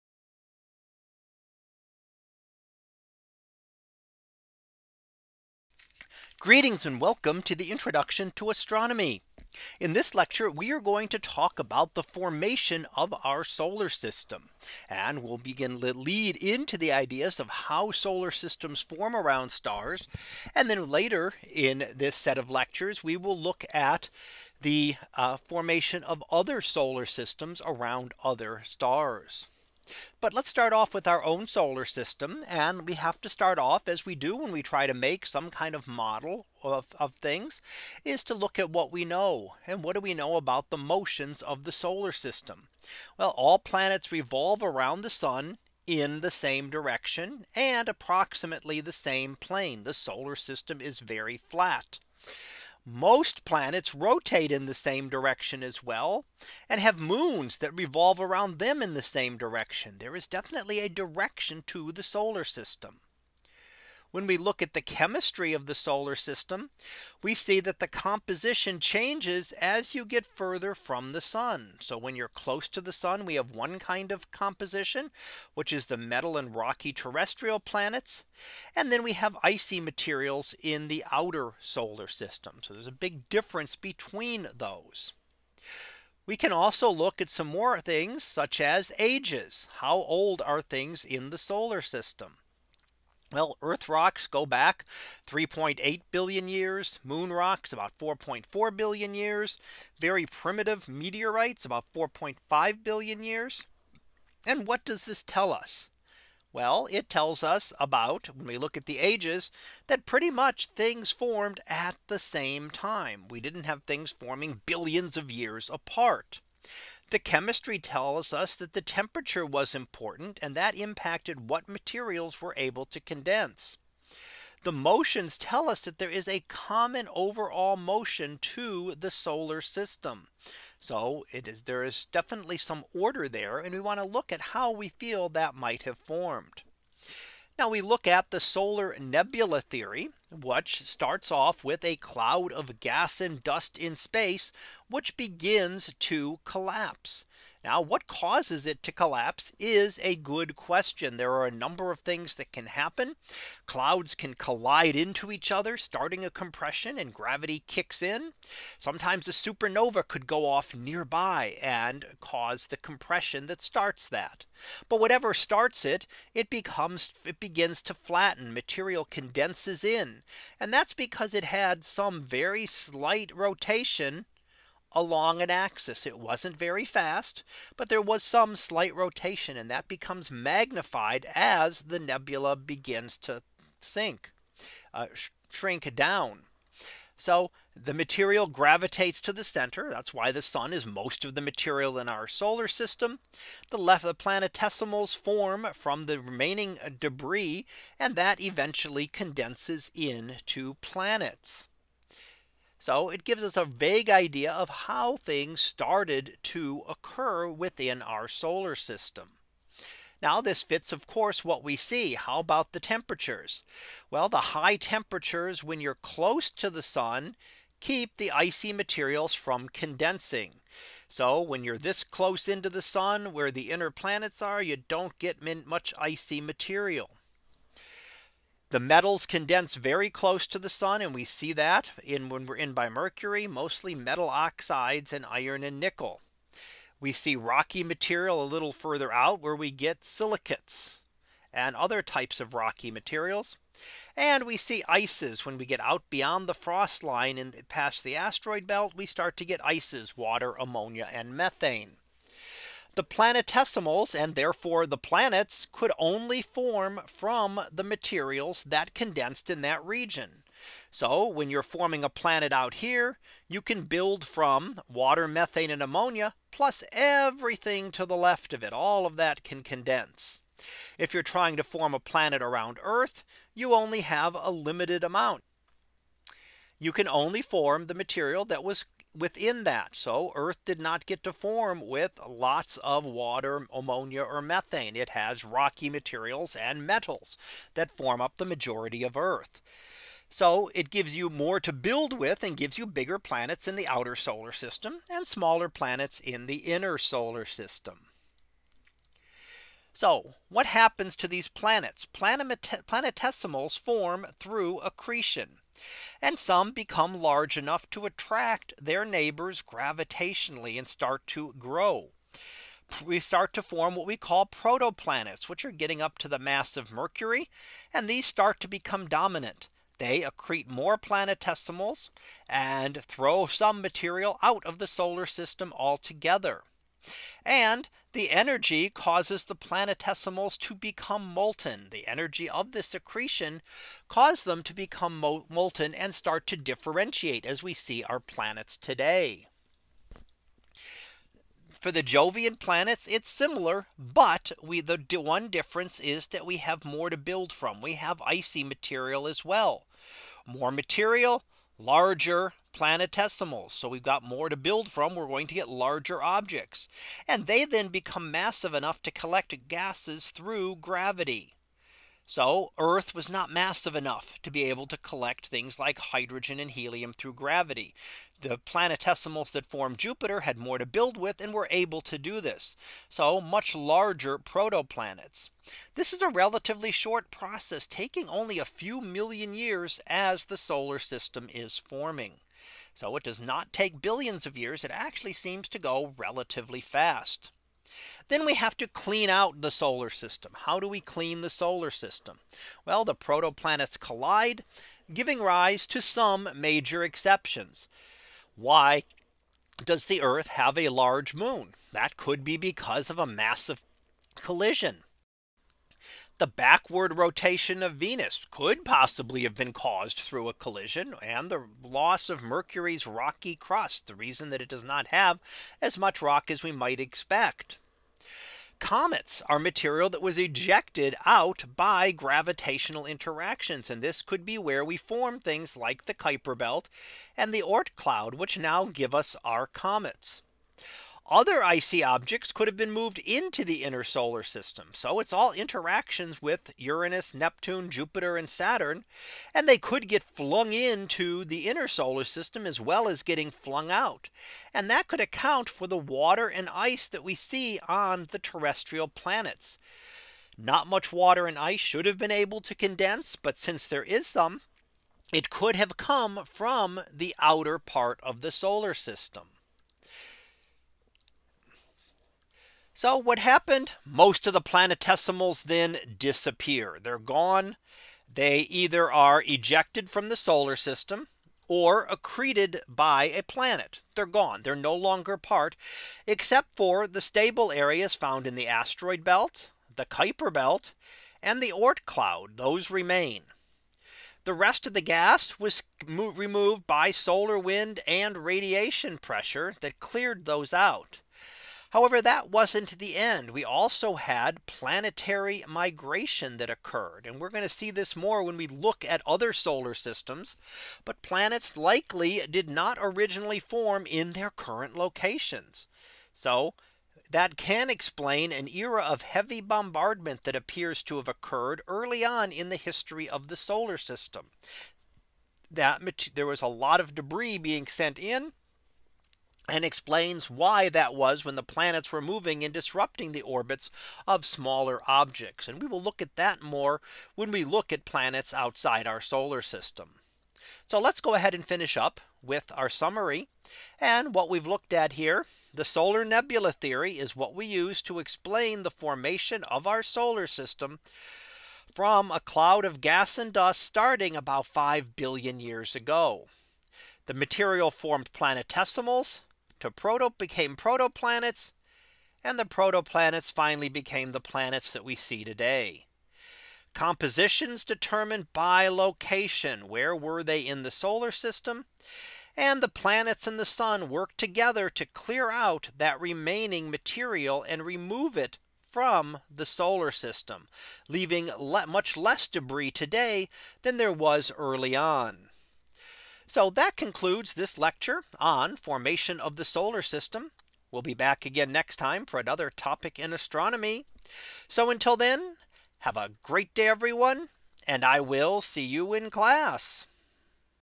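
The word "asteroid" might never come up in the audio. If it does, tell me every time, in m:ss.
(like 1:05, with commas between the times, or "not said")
4:08, 7:58.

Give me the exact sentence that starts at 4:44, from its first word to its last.
It has rocky materials and metals that form up the majority of Earth.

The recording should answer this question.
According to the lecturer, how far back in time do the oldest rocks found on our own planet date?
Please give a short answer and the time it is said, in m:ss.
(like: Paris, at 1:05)
3.8 billion years, at 1:35.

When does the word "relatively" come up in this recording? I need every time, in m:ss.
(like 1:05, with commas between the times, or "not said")
6:16, 6:26.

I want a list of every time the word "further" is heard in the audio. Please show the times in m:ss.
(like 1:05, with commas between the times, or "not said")
1:10, 3:58.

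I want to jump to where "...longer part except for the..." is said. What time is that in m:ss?
7:54.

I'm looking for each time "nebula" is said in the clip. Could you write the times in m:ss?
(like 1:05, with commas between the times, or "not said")
2:18, 3:01, 8:56.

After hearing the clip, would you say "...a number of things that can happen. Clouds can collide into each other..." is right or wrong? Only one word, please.
right.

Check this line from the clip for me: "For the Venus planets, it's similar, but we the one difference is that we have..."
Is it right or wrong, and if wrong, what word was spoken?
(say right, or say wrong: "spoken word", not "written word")
wrong: "Jovian", not "Venus".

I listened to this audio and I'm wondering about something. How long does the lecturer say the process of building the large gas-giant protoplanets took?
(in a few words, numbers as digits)
a few million years.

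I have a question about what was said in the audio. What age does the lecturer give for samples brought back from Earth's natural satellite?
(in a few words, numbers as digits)
4.4 billion years.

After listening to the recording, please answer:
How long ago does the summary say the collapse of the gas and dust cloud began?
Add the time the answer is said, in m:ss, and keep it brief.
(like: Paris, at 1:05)
about 5 billion years, at 9:04.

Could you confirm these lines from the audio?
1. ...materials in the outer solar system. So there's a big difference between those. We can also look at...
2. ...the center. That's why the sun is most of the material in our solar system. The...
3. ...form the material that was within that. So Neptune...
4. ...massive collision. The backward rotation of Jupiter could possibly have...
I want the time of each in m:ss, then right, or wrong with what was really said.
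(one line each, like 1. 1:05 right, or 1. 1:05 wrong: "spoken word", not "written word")
1. 1:19 right
2. 3:09 right
3. 4:37 wrong: "Earth", not "Neptune"
4. 6:43 wrong: "Venus", not "Jupiter".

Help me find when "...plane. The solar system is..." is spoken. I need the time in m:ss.
0:49.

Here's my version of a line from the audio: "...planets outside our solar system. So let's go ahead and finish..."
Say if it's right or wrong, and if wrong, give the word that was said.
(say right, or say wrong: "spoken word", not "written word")
right.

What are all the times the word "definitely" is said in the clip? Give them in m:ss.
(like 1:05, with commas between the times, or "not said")
1:00, 2:12.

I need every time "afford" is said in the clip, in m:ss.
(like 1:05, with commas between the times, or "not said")
not said.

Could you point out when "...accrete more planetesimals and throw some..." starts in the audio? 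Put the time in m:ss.
5:20.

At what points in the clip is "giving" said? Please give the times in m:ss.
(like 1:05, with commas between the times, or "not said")
6:35.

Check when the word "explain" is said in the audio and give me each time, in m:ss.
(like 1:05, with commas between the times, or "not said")
8:27, 8:39, 8:58.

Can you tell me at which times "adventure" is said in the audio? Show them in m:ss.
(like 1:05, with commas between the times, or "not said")
not said.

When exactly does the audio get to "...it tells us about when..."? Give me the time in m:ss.
1:46.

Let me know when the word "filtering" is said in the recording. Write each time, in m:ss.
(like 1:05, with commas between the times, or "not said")
not said.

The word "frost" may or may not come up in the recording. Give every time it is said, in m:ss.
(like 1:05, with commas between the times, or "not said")
4:06.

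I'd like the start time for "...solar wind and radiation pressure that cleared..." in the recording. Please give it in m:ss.
8:07.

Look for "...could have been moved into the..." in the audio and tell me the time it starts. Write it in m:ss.
7:12.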